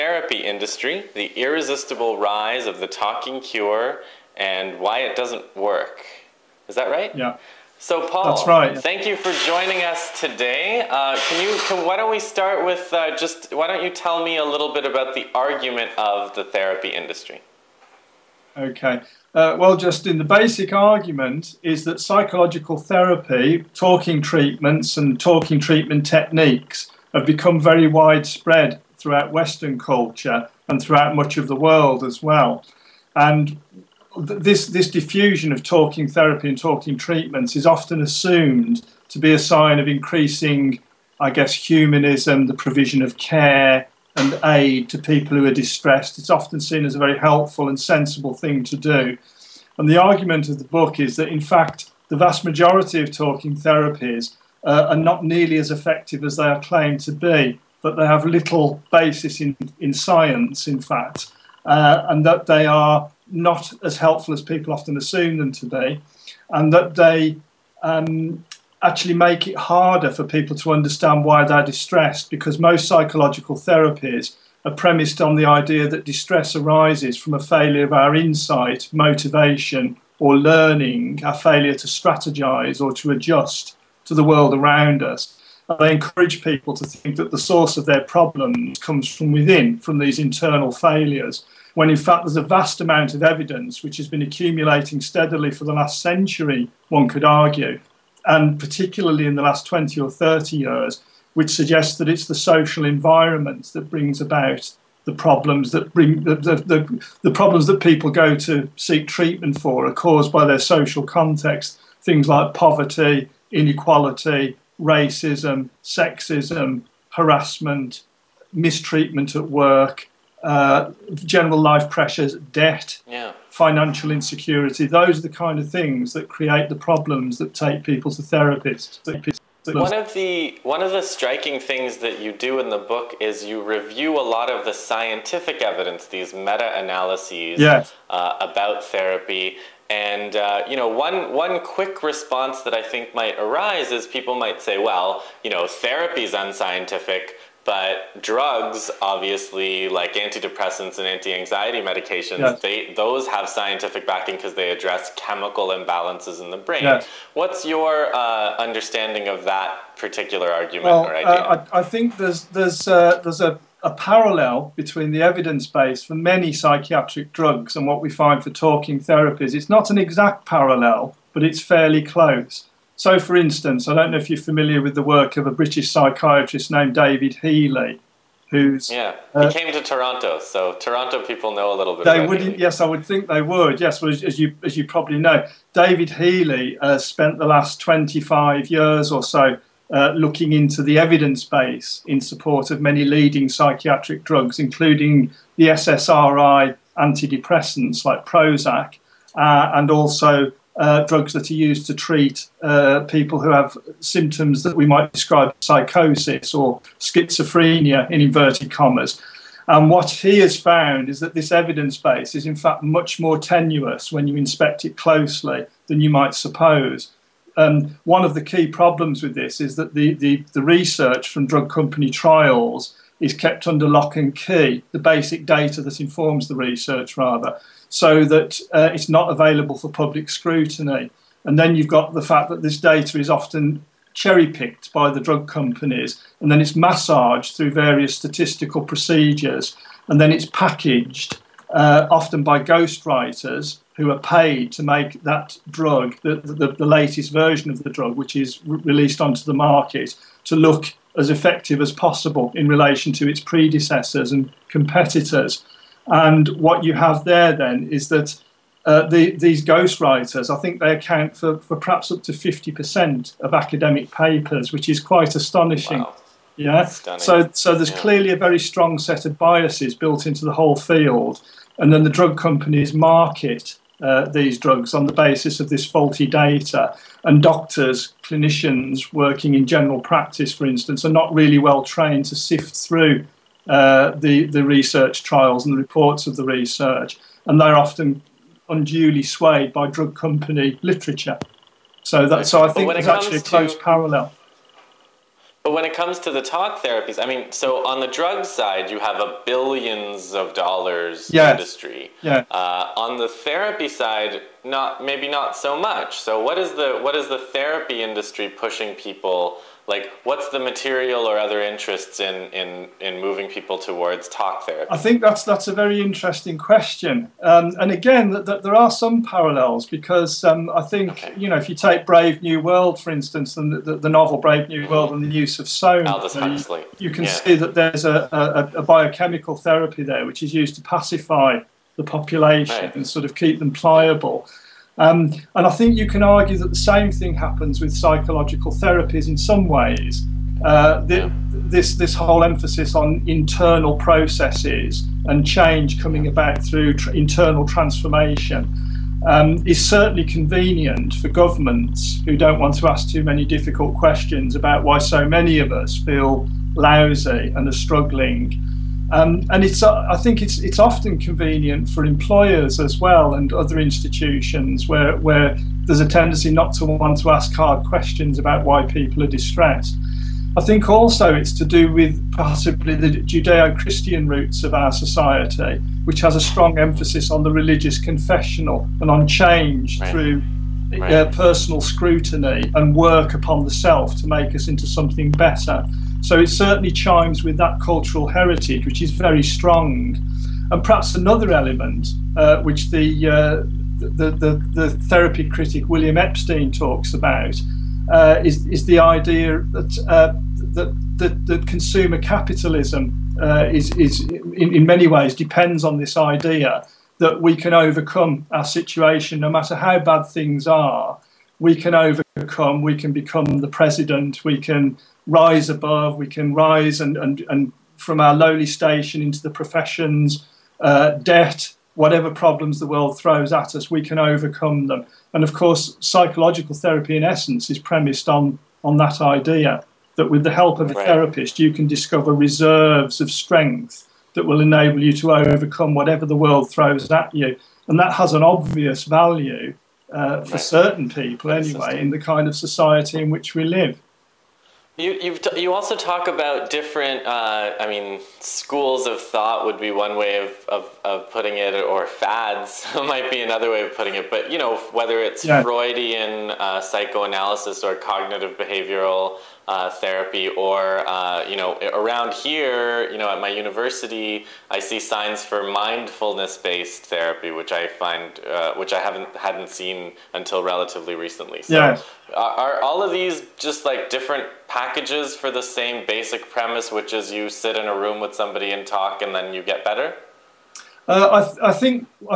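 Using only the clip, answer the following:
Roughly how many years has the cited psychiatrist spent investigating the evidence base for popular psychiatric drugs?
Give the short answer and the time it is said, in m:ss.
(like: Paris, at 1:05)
25, at 3:07.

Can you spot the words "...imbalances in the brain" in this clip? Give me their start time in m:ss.
2:35.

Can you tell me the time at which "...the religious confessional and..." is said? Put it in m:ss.
6:17.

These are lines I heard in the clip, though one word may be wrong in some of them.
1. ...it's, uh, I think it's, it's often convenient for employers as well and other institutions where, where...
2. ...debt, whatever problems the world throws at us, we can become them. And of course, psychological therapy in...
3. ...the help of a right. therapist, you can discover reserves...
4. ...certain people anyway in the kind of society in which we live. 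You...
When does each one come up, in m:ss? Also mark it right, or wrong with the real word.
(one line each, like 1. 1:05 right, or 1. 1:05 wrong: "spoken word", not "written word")
1. 5:59 right
2. 7:01 wrong: "overcome", not "become"
3. 7:10 right
4. 7:20 right.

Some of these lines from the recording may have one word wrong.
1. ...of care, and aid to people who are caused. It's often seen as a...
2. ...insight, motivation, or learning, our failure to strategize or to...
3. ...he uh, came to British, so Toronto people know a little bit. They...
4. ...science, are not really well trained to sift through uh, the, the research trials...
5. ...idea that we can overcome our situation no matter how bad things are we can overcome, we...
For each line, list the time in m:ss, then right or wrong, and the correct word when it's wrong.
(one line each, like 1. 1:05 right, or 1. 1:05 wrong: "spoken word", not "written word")
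1. 0:43 wrong: "distressed", not "caused"
2. 1:18 right
3. 2:59 wrong: "Toronto", not "British"
4. 4:40 wrong: "instance", not "science"
5. 6:46 right.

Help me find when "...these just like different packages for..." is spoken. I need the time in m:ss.
7:53.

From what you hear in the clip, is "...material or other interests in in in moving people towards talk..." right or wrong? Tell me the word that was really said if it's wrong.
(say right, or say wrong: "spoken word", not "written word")
right.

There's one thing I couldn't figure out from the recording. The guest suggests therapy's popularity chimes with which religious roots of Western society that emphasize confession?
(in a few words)
Judeo Christian.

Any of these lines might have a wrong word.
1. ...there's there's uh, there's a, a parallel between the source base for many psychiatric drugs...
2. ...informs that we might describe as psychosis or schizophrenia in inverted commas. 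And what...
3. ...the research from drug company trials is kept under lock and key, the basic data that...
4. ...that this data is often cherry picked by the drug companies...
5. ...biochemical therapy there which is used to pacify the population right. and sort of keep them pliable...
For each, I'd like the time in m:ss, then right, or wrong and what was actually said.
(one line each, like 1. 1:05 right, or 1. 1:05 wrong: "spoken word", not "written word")
1. 2:42 wrong: "evidence", not "source"
2. 3:23 wrong: "symptoms", not "informs"
3. 3:40 right
4. 3:52 right
5. 5:28 right.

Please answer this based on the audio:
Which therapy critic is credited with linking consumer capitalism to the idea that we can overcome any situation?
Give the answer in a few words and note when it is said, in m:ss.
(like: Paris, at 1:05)
William Epstein, at 6:35.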